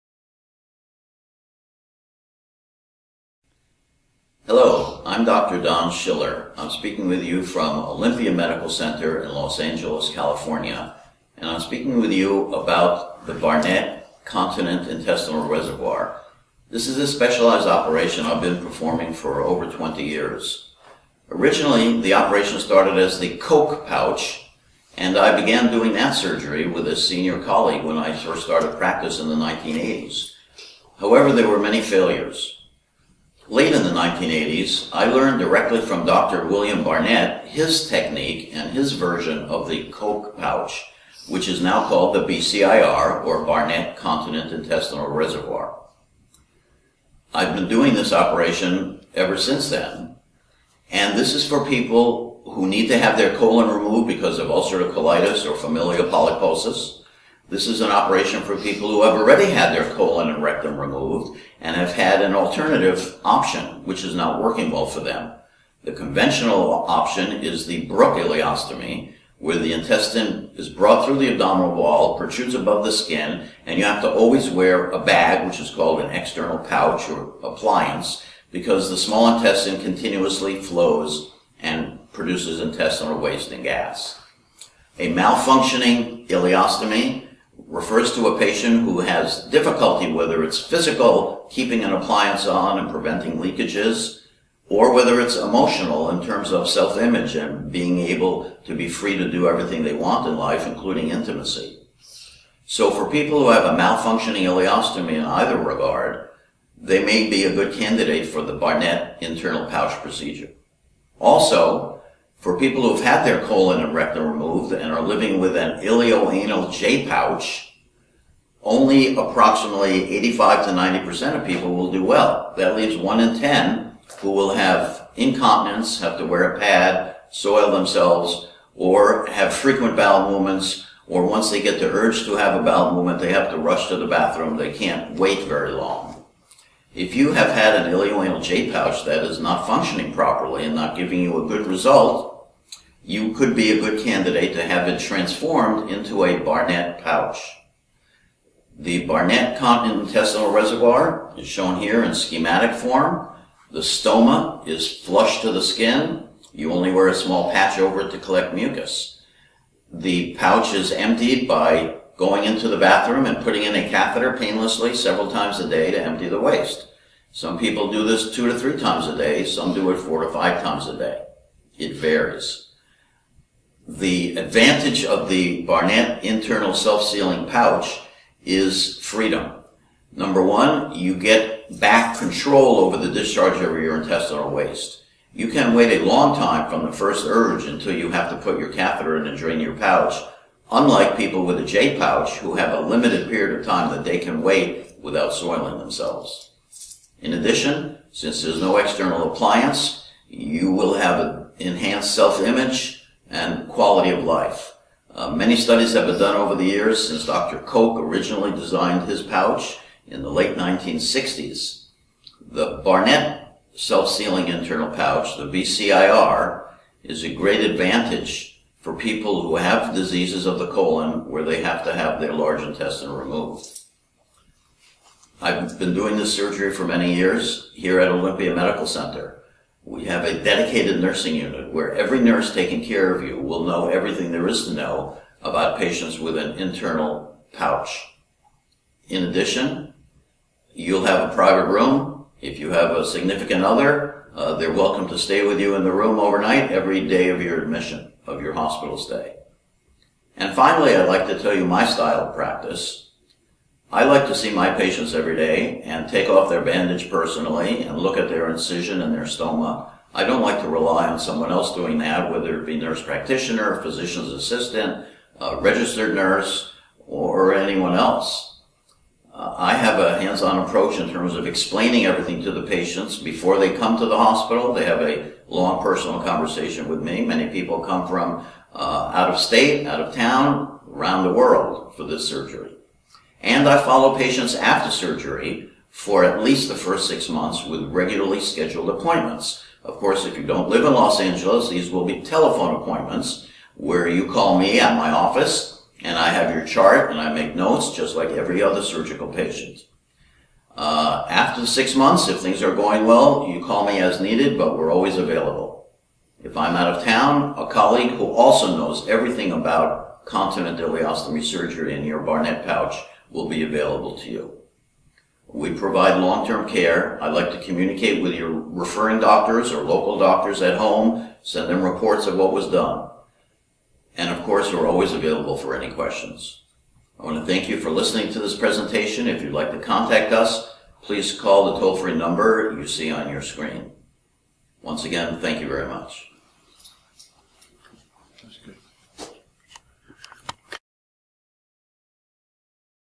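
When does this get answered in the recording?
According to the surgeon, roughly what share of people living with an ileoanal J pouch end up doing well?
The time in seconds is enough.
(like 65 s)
120 s.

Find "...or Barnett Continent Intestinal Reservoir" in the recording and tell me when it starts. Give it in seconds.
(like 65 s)
43 s.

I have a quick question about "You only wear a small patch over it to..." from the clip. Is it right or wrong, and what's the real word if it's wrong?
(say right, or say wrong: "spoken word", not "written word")
right.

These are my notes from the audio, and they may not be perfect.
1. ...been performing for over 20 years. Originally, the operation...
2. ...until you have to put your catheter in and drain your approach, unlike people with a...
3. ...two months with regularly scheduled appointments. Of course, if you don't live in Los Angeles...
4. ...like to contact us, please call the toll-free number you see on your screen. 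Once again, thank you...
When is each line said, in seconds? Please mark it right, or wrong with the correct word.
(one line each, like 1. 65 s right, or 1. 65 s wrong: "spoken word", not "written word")
1. 18 s right
2. 187 s wrong: "pouch", not "approach"
3. 287 s wrong: "six", not "two"
4. 329 s right.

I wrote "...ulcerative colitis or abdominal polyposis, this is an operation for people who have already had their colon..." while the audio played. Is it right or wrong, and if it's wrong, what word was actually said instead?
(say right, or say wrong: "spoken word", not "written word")
wrong: "familial", not "abdominal".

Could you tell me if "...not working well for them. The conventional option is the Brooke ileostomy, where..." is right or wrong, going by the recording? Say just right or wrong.
right.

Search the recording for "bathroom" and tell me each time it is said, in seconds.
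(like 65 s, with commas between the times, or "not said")
134 s, 162 s.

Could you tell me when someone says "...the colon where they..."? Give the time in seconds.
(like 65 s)
220 s.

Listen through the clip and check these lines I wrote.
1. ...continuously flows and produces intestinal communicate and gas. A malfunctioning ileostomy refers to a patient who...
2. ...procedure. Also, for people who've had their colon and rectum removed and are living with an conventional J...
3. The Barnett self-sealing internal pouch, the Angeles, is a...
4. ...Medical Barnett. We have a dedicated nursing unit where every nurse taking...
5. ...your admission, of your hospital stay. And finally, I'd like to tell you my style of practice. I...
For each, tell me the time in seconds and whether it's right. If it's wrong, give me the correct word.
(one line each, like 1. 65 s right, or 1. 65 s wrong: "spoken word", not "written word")
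1. 79 s wrong: "waste", not "communicate"
2. 110 s wrong: "ileoanal", not "conventional"
3. 212 s wrong: "BCIR", not "Angeles"
4. 228 s wrong: "Center", not "Barnett"
5. 247 s right.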